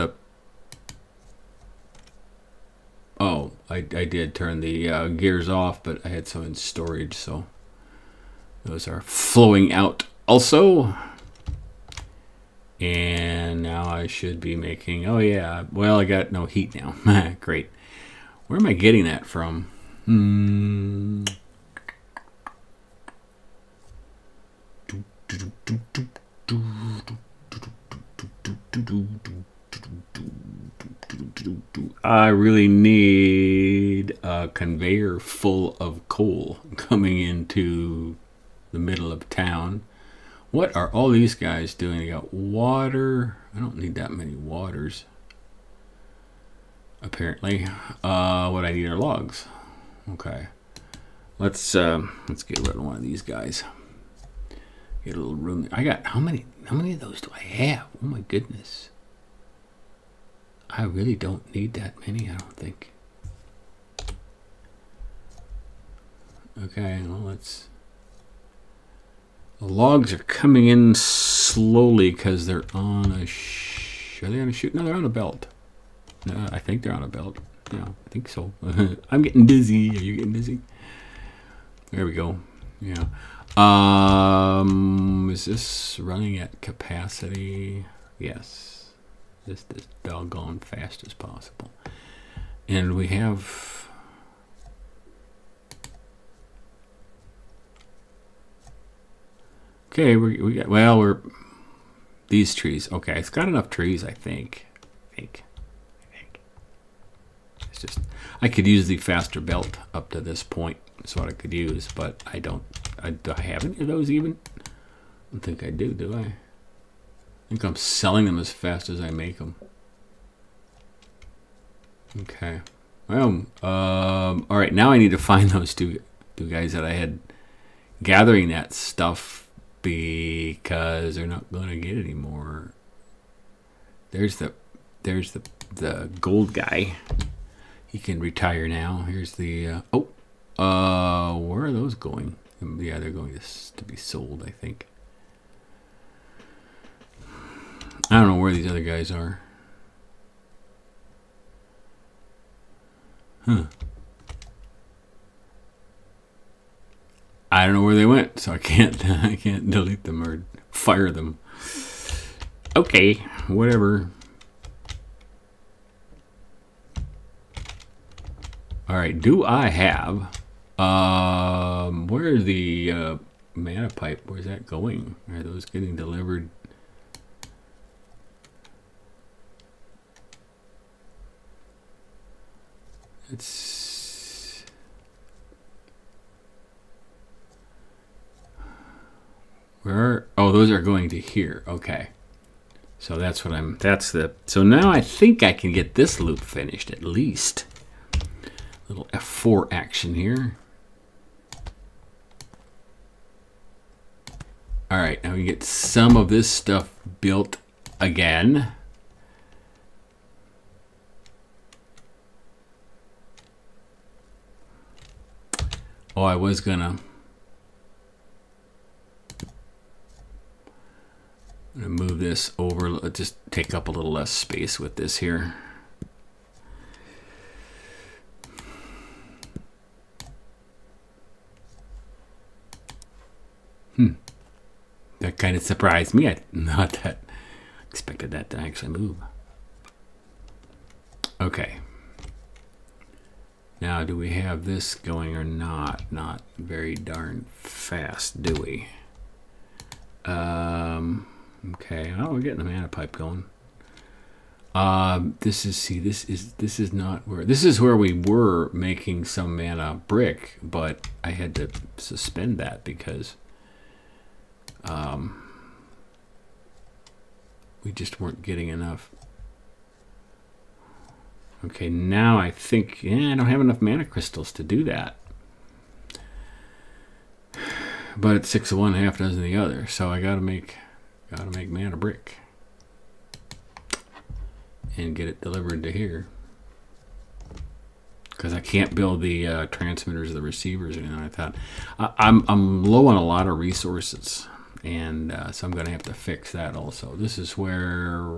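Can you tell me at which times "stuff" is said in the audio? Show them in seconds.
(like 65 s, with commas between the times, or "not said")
128 s, 206 s.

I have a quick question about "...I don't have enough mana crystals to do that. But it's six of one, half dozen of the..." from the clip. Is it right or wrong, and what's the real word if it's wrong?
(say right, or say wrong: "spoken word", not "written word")
right.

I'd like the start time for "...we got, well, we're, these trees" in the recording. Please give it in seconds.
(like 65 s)
100 s.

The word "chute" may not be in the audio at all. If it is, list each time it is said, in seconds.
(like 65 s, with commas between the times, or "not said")
74 s.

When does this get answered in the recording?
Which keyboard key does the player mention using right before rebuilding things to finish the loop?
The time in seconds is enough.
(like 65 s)
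199 s.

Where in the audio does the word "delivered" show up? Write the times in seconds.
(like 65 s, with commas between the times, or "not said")
175 s, 285 s.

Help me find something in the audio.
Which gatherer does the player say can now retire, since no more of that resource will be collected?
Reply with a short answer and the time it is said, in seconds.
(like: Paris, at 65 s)
The gold guy, at 135 s.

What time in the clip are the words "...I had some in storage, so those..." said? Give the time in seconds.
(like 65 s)
6 s.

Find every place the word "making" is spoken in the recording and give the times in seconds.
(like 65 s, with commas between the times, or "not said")
14 s, 258 s.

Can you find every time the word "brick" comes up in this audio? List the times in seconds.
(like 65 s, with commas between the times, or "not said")
260 s, 281 s.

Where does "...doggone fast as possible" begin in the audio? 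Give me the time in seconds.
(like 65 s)
90 s.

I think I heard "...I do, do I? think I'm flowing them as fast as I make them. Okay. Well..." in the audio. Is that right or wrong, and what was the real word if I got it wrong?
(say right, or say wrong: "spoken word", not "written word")
wrong: "selling", not "flowing".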